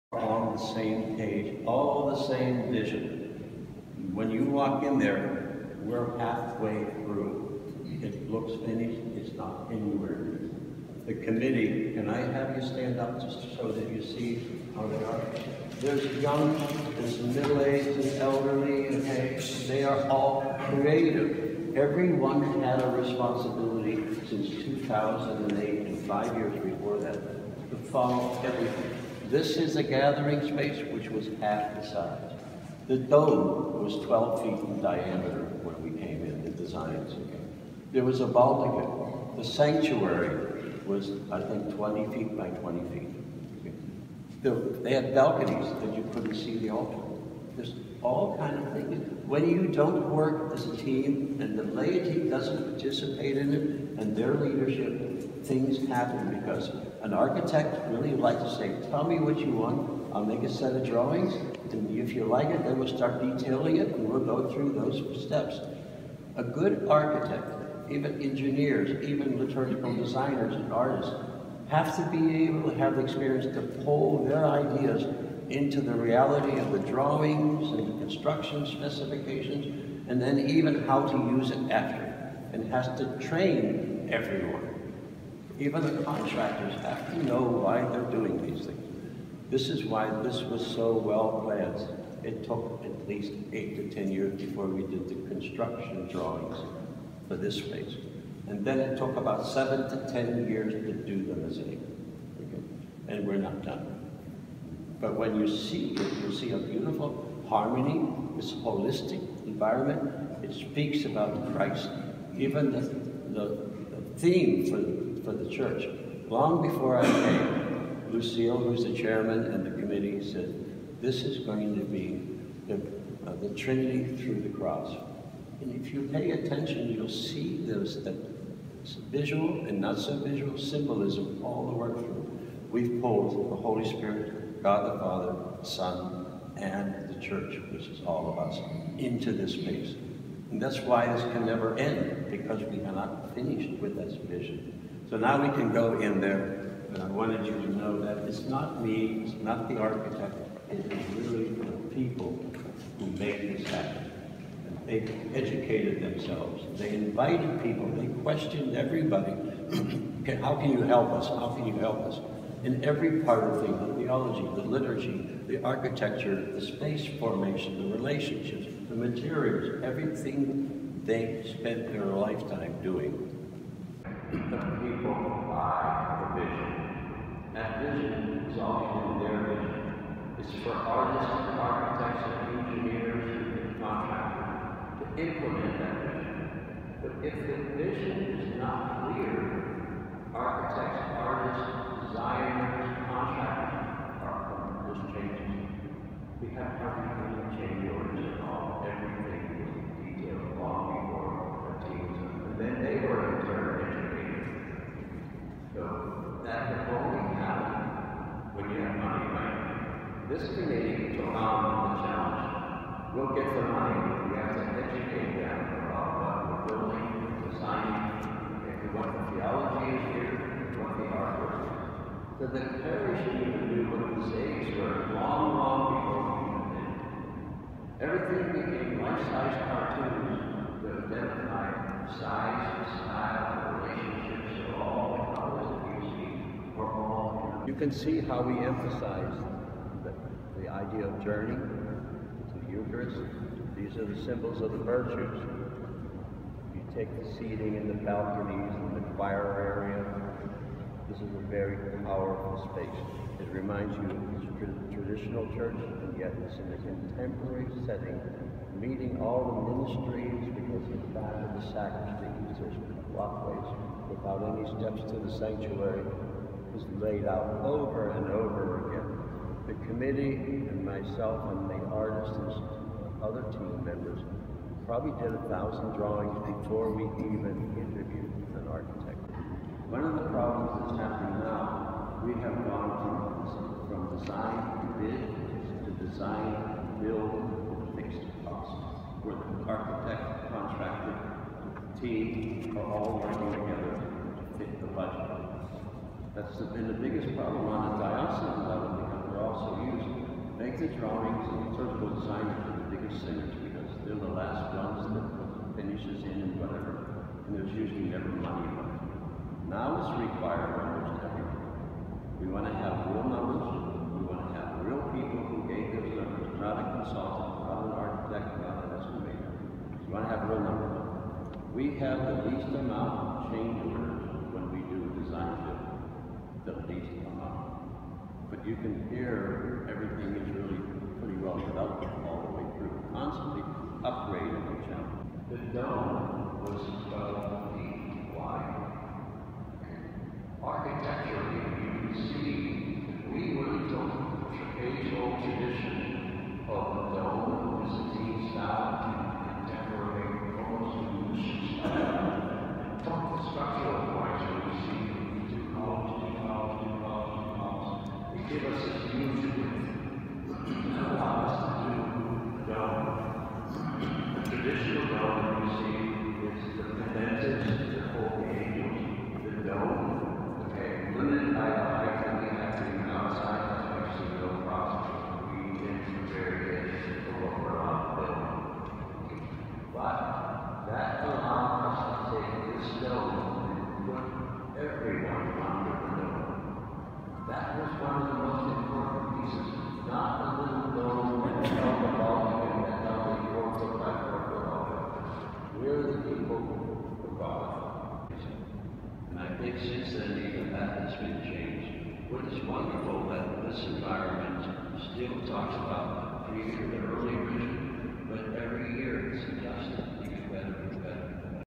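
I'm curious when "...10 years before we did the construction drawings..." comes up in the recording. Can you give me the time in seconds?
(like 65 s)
93 s.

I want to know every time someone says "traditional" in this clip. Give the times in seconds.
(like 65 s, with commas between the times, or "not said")
254 s, 364 s.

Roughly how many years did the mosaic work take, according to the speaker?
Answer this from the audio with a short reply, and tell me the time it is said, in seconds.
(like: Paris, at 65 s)
7 to 10 years, at 99 s.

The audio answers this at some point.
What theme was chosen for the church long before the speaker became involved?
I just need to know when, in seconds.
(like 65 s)
123 s.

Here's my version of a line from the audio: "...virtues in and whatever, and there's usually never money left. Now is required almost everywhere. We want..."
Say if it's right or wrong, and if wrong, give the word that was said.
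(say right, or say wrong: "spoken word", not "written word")
wrong: "finishes", not "virtues".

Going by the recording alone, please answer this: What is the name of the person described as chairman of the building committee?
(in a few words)
Lucille.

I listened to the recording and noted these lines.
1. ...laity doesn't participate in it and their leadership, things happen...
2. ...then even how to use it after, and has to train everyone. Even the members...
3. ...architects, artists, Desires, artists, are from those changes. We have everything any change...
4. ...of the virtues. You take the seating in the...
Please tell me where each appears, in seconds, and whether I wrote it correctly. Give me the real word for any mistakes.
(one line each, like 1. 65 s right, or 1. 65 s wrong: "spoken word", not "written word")
1. 51 s right
2. 80 s wrong: "contractors", not "members"
3. 190 s wrong: "contracts", not "artists"
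4. 244 s right.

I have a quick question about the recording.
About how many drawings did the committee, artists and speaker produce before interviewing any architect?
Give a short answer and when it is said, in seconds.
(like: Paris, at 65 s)
1000, at 275 s.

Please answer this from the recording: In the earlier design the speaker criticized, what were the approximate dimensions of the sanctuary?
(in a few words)
20 feet by 20 feet.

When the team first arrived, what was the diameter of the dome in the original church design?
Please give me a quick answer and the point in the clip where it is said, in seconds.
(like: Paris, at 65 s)
12 feet, at 34 s.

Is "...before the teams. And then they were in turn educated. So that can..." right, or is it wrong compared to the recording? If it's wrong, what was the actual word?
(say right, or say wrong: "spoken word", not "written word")
right.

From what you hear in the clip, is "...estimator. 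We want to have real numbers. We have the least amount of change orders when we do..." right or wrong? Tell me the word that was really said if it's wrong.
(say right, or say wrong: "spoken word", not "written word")
right.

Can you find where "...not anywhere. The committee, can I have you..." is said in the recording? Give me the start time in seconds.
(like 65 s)
9 s.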